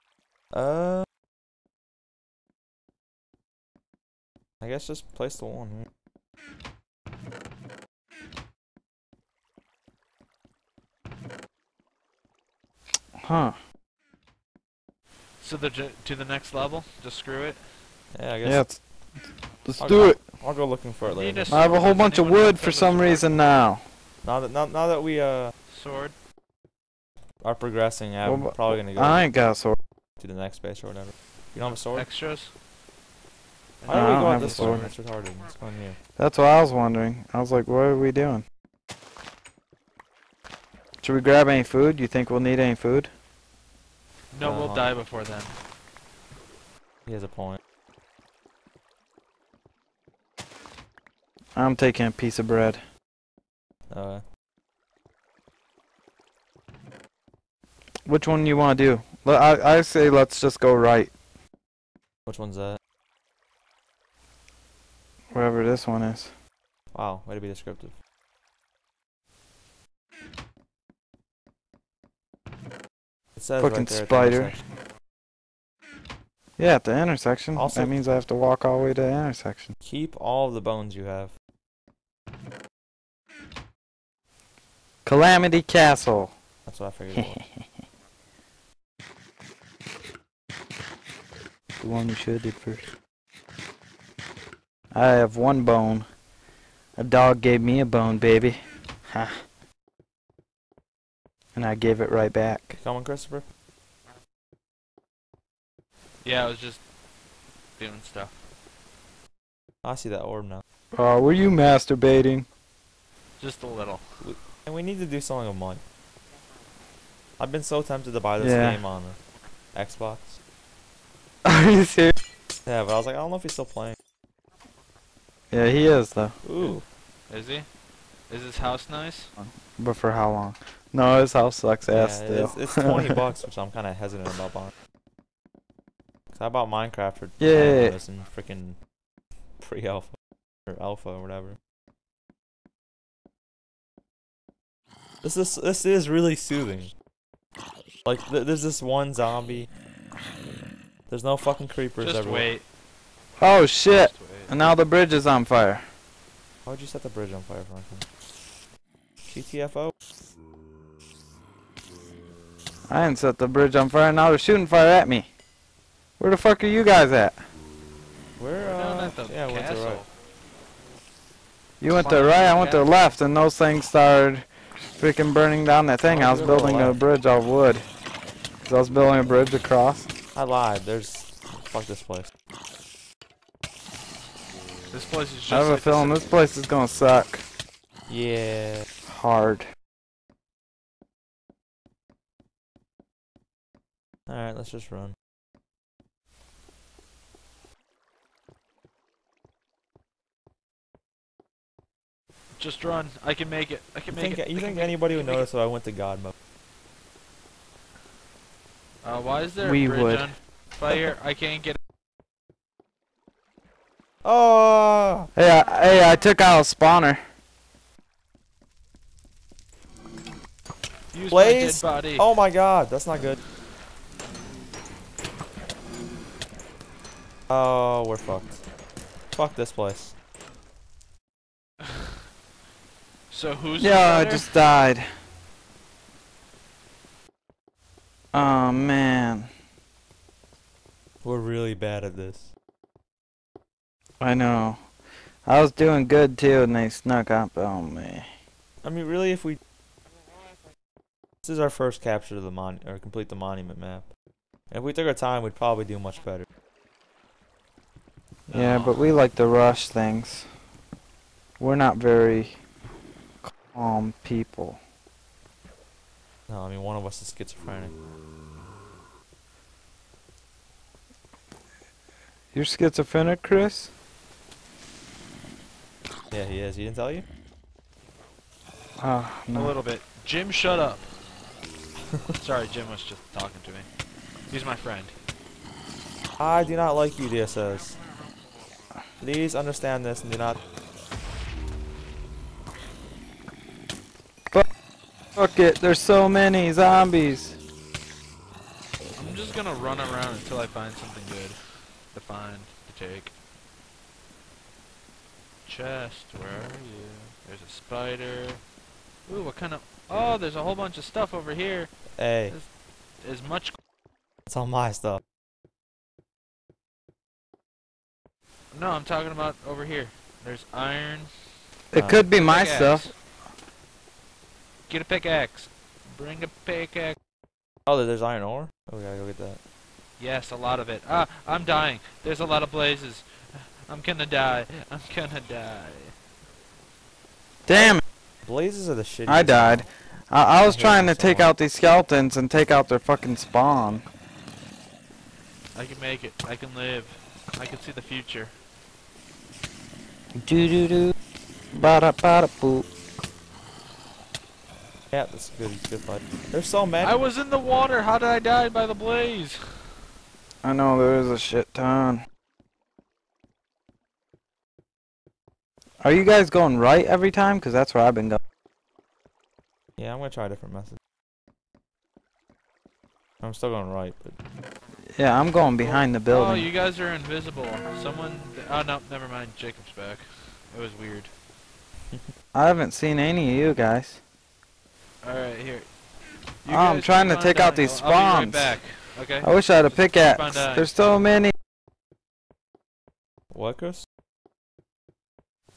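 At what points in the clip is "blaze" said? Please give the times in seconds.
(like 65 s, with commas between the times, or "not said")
221 s, 332 s, 338 s, 358 s.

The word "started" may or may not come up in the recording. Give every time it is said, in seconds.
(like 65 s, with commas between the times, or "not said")
173 s.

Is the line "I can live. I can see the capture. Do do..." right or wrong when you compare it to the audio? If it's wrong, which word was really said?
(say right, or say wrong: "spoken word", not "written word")
wrong: "future", not "capture".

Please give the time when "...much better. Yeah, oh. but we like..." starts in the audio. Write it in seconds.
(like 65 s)
255 s.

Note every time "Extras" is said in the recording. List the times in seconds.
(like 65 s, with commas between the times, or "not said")
32 s.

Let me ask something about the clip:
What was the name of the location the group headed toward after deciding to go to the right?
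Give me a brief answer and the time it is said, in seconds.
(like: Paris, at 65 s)
Calamity Castle, at 85 s.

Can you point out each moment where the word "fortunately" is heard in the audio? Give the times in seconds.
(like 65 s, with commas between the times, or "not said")
not said.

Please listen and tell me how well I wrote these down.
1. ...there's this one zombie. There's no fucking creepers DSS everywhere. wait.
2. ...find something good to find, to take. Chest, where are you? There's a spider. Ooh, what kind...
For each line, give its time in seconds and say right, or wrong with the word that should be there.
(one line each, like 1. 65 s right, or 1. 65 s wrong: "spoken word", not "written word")
1. 148 s wrong: "Just", not "DSS"
2. 300 s right.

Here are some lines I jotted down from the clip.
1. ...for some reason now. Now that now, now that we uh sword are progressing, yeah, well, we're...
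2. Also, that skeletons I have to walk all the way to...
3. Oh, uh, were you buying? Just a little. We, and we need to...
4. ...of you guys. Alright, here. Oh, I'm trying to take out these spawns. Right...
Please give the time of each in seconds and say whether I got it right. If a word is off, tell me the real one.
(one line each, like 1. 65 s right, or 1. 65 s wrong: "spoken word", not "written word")
1. 22 s right
2. 77 s wrong: "means", not "skeletons"
3. 110 s wrong: "masturbating", not "buying"
4. 383 s right.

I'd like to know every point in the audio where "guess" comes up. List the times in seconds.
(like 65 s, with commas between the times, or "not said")
4 s, 18 s.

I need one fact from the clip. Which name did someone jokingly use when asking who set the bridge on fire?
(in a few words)
Franklin.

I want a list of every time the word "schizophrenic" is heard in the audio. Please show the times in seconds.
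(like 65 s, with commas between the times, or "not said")
267 s, 272 s.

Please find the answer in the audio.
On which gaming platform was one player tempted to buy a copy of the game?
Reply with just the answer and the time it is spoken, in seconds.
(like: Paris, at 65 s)
Xbox, at 119 s.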